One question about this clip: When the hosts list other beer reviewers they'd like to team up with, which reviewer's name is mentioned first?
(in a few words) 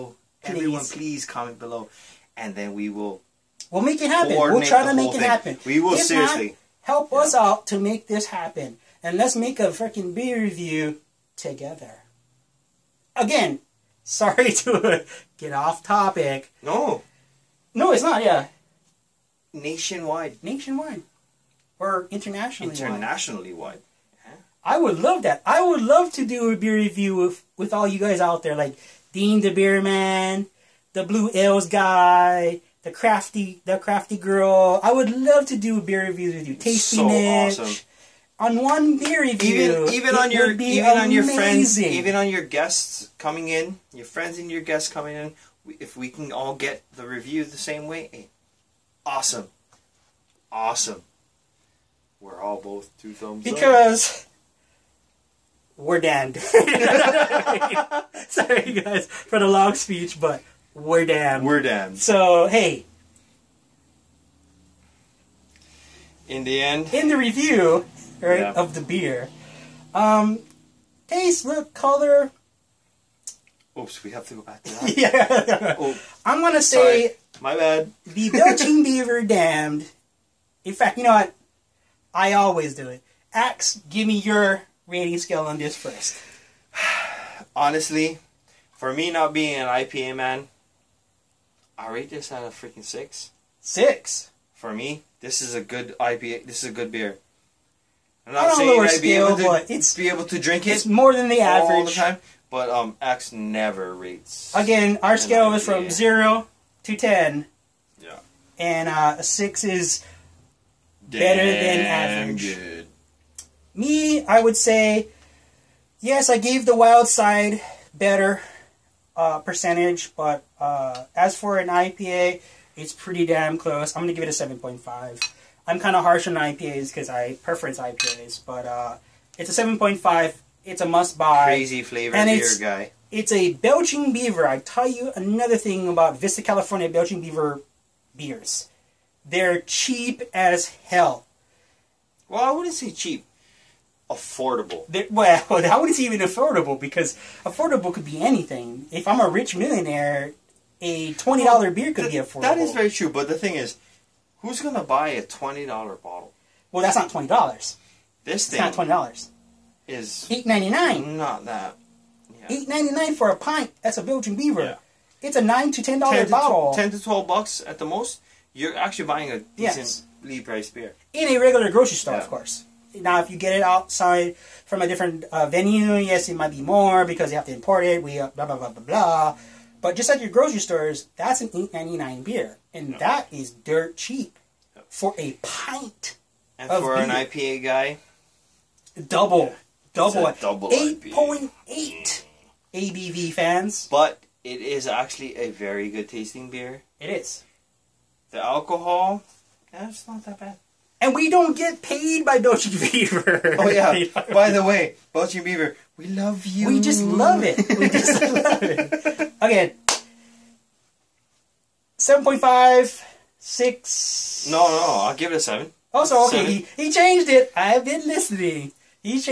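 Dean the Beer Man.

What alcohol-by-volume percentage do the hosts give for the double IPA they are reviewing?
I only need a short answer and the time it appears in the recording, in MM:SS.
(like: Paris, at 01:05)
8.8, at 03:10.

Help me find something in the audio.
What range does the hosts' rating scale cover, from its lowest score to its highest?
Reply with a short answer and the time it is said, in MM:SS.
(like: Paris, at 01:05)
0 to 10, at 01:45.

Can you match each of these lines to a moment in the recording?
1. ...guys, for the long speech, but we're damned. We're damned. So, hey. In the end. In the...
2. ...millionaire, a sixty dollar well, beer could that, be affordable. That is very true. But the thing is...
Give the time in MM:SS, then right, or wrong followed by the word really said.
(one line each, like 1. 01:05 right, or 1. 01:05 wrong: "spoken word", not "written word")
1. 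00:58 right
2. 02:29 wrong: "twenty", not "sixty".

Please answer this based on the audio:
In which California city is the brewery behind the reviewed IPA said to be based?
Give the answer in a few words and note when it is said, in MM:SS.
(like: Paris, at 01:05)
Vista, at 02:16.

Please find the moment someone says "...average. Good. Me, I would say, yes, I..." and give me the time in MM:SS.
01:51.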